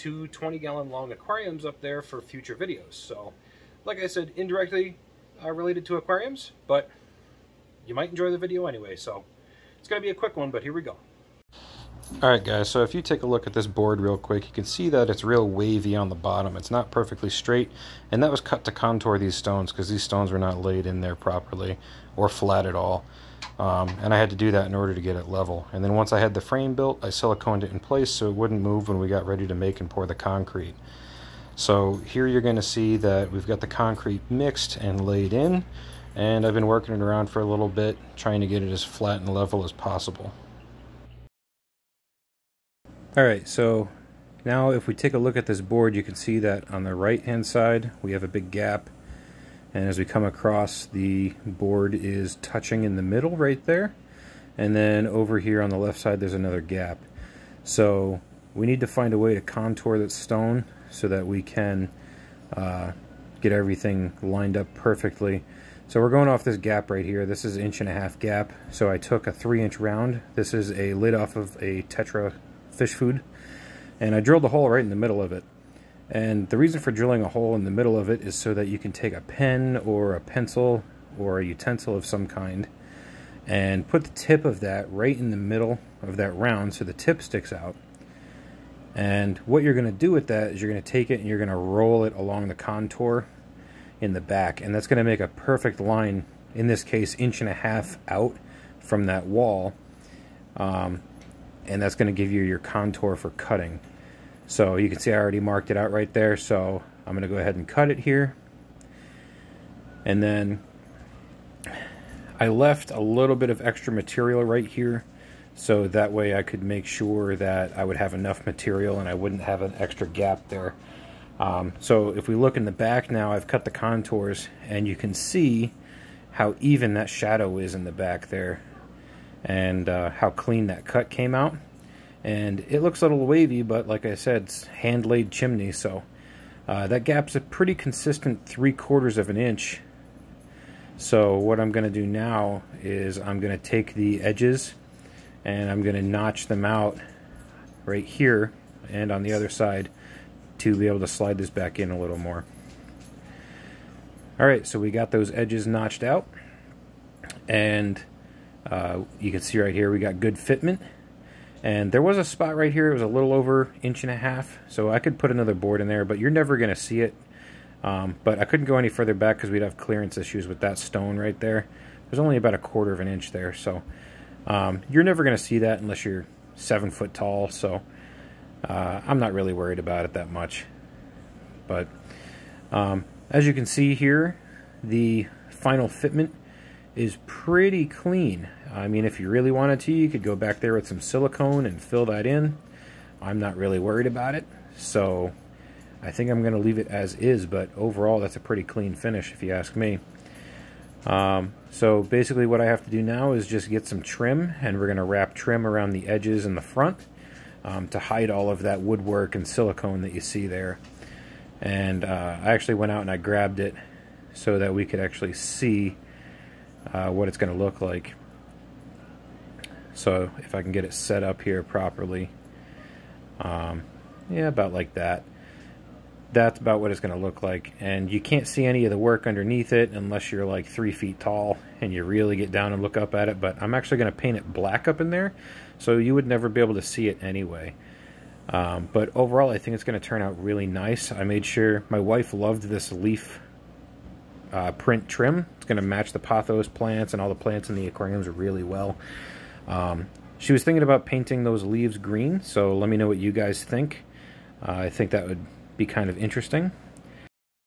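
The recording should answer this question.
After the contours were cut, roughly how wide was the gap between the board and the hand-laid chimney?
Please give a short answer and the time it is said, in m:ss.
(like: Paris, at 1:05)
3/4 inch, at 2:18.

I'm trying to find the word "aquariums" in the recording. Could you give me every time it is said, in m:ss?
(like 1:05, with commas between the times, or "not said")
0:01, 0:05, 4:07.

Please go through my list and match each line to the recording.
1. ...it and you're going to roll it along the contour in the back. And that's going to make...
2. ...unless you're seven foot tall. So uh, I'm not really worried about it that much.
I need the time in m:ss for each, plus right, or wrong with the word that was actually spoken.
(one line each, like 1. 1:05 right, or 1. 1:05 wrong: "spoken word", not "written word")
1. 1:31 right
2. 2:55 right.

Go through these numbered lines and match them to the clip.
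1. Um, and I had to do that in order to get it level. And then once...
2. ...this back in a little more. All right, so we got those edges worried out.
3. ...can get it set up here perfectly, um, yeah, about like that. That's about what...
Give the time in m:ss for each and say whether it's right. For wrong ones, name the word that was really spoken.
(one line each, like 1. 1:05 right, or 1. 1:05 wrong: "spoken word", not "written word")
1. 0:23 right
2. 2:31 wrong: "notched", not "worried"
3. 3:40 wrong: "properly", not "perfectly".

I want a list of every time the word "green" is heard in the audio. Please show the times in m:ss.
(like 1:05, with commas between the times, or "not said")
4:11.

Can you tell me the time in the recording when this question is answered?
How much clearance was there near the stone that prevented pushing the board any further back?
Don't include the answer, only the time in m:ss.
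2:52.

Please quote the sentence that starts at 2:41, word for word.
And there was a spot right here, it was a little over inch and a half.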